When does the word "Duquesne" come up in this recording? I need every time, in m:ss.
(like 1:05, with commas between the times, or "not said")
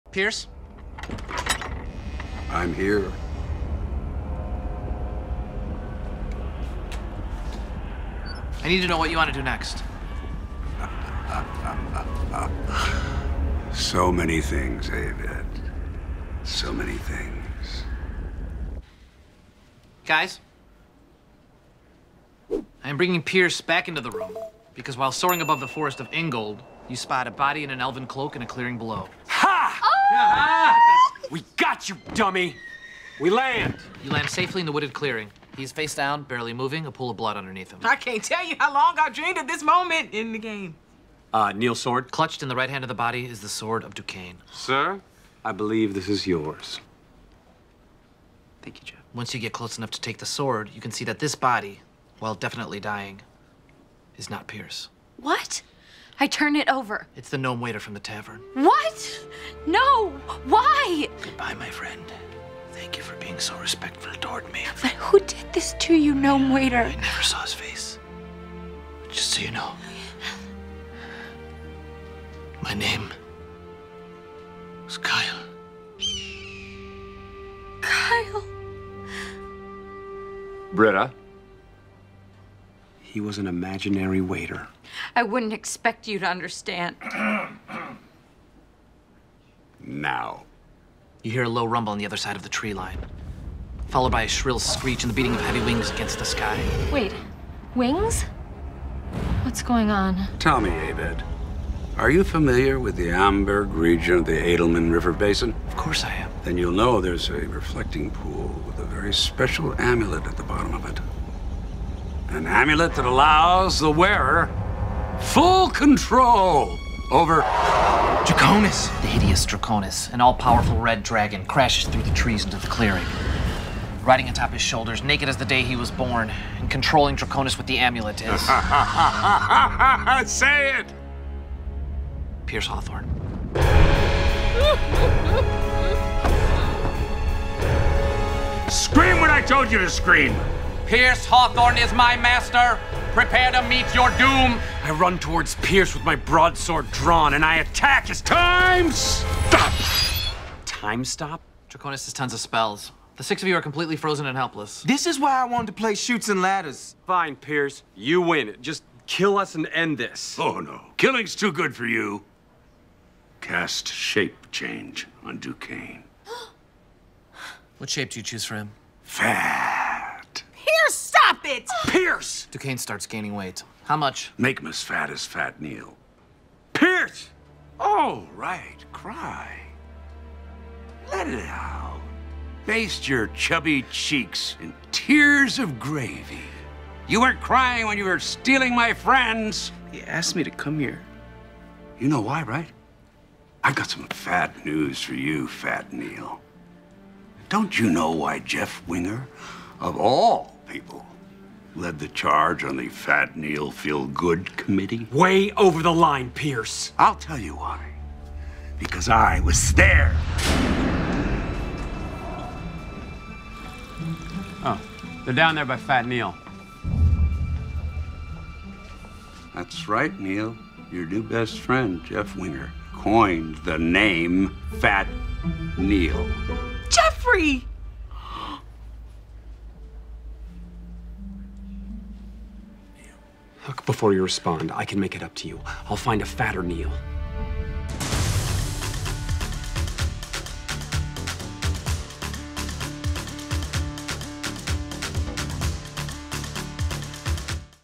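0:43, 2:45, 2:52.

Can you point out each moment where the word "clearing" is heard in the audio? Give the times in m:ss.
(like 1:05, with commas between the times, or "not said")
0:28, 0:34, 2:02.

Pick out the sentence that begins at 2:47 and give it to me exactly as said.
what shape do you choose for him?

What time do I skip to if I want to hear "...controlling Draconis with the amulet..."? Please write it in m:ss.
2:06.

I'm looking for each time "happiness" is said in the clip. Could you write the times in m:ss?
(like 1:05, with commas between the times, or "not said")
not said.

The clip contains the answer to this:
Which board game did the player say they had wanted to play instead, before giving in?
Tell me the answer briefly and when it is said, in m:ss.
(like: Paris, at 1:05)
Chutes and Ladders, at 2:35.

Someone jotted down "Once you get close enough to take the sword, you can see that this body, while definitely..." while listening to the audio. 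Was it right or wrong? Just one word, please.
right.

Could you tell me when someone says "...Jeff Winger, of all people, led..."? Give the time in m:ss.
3:18.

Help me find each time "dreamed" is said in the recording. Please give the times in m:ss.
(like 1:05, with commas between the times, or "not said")
0:39.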